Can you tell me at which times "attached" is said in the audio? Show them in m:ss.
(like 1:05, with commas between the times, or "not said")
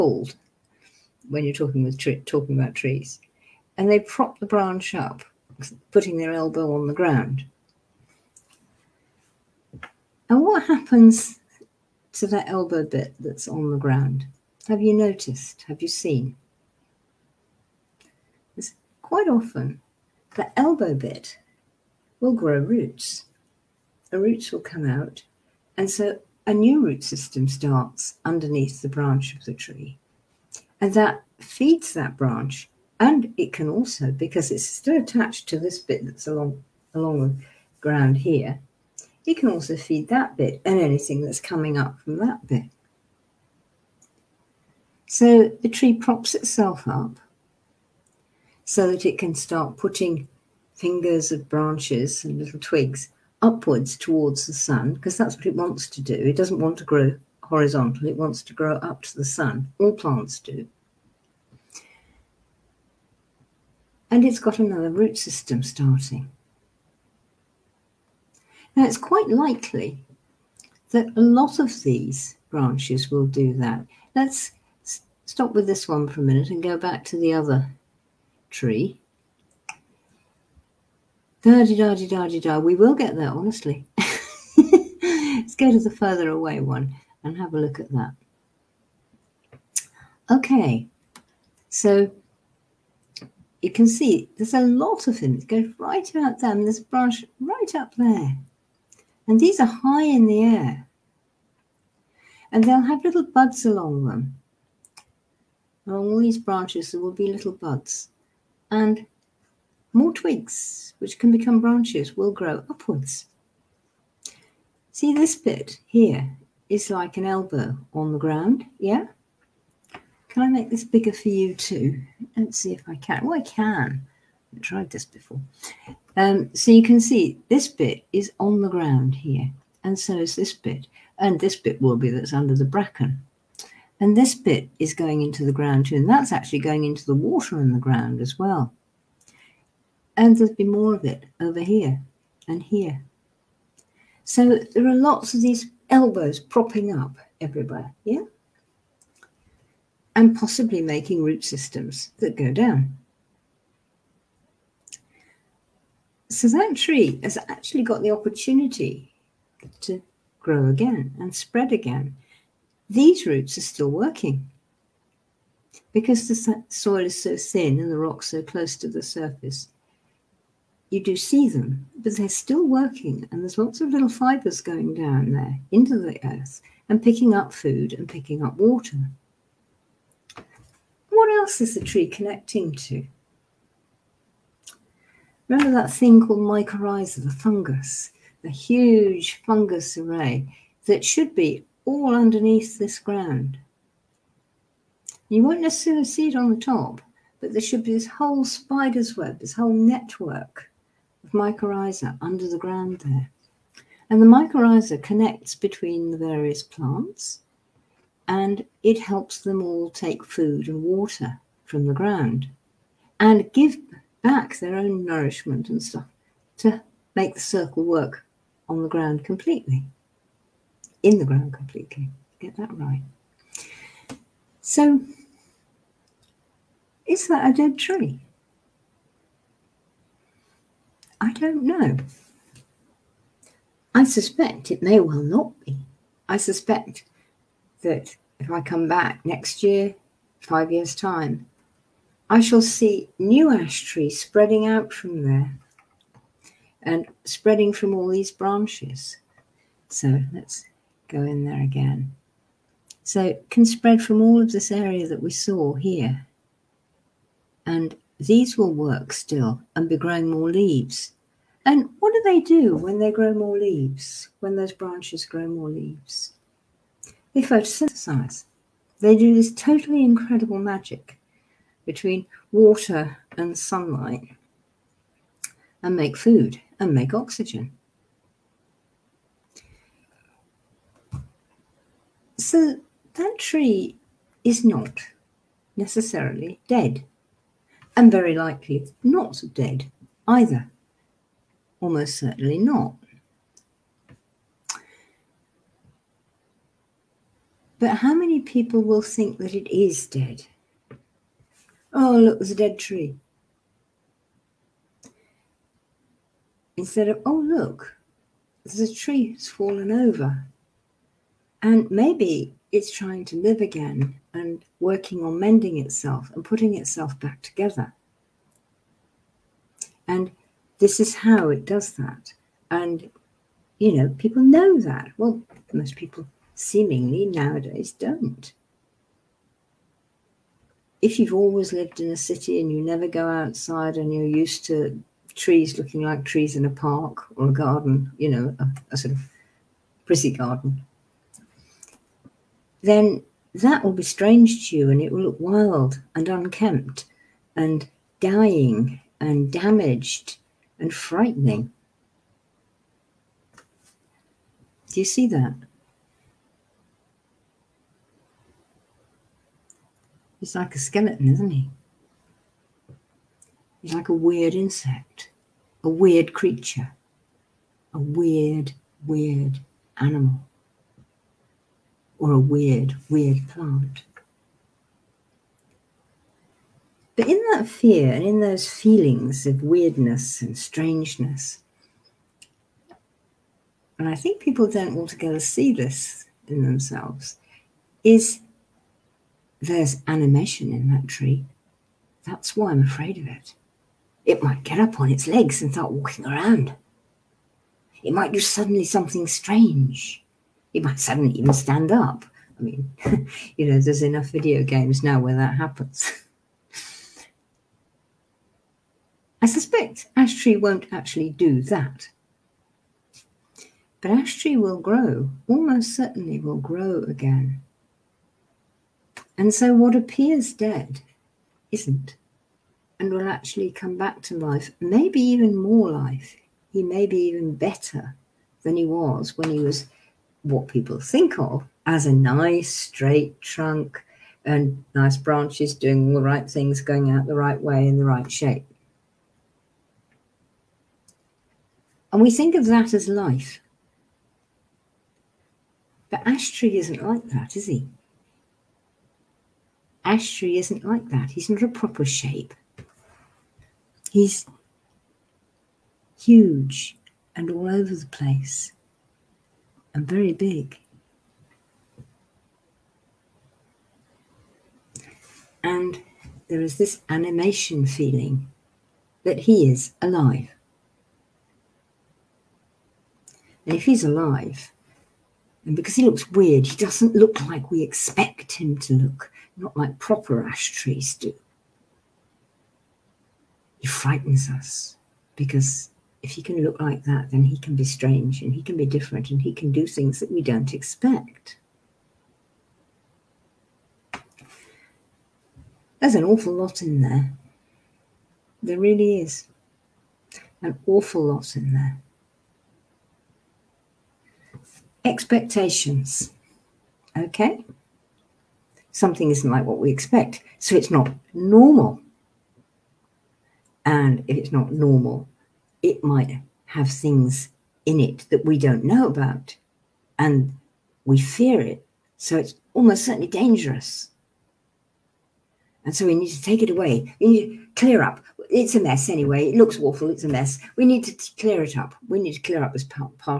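0:35.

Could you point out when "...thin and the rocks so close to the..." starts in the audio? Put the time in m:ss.
2:47.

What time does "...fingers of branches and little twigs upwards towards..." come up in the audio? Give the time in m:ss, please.
0:50.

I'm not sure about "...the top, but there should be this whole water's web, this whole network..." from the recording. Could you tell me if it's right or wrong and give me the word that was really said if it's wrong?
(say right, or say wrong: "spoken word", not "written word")
wrong: "spider", not "water".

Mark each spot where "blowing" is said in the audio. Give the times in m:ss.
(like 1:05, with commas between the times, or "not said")
not said.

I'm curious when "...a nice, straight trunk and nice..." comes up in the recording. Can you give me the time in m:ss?
7:12.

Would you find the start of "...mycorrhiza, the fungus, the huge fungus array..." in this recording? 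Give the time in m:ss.
3:06.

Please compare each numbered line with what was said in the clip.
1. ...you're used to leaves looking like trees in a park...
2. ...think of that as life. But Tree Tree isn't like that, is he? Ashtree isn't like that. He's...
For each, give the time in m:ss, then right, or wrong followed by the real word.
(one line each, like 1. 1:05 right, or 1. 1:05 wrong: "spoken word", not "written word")
1. 5:34 wrong: "trees", not "leaves"
2. 7:22 wrong: "Ash", not "Tree".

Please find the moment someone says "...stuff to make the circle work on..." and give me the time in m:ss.
3:35.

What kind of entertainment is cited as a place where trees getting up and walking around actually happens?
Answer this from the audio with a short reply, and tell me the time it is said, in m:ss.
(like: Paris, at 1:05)
Video games, at 6:44.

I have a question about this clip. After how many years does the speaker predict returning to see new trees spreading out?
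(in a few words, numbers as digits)
5.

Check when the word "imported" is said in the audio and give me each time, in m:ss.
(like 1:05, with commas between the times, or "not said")
not said.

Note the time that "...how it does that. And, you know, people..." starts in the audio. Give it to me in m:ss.
5:21.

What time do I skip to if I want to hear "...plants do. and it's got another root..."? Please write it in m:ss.
0:59.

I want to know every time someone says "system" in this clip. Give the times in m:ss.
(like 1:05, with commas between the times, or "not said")
0:27, 1:05, 2:31.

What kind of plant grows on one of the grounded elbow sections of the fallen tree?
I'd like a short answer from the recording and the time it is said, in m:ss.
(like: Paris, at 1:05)
Bracken, at 2:12.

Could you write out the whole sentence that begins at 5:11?
And maybe it's trying to live again and working on mending itself and putting itself back together.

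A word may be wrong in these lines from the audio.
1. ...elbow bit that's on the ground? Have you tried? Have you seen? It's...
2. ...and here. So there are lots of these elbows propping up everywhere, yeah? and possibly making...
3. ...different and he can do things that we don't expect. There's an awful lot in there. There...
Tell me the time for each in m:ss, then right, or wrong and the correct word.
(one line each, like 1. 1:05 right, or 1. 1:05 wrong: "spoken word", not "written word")
1. 0:12 wrong: "noticed", not "tried"
2. 2:22 right
3. 8:08 right.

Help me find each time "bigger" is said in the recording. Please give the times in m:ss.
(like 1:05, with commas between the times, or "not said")
2:00.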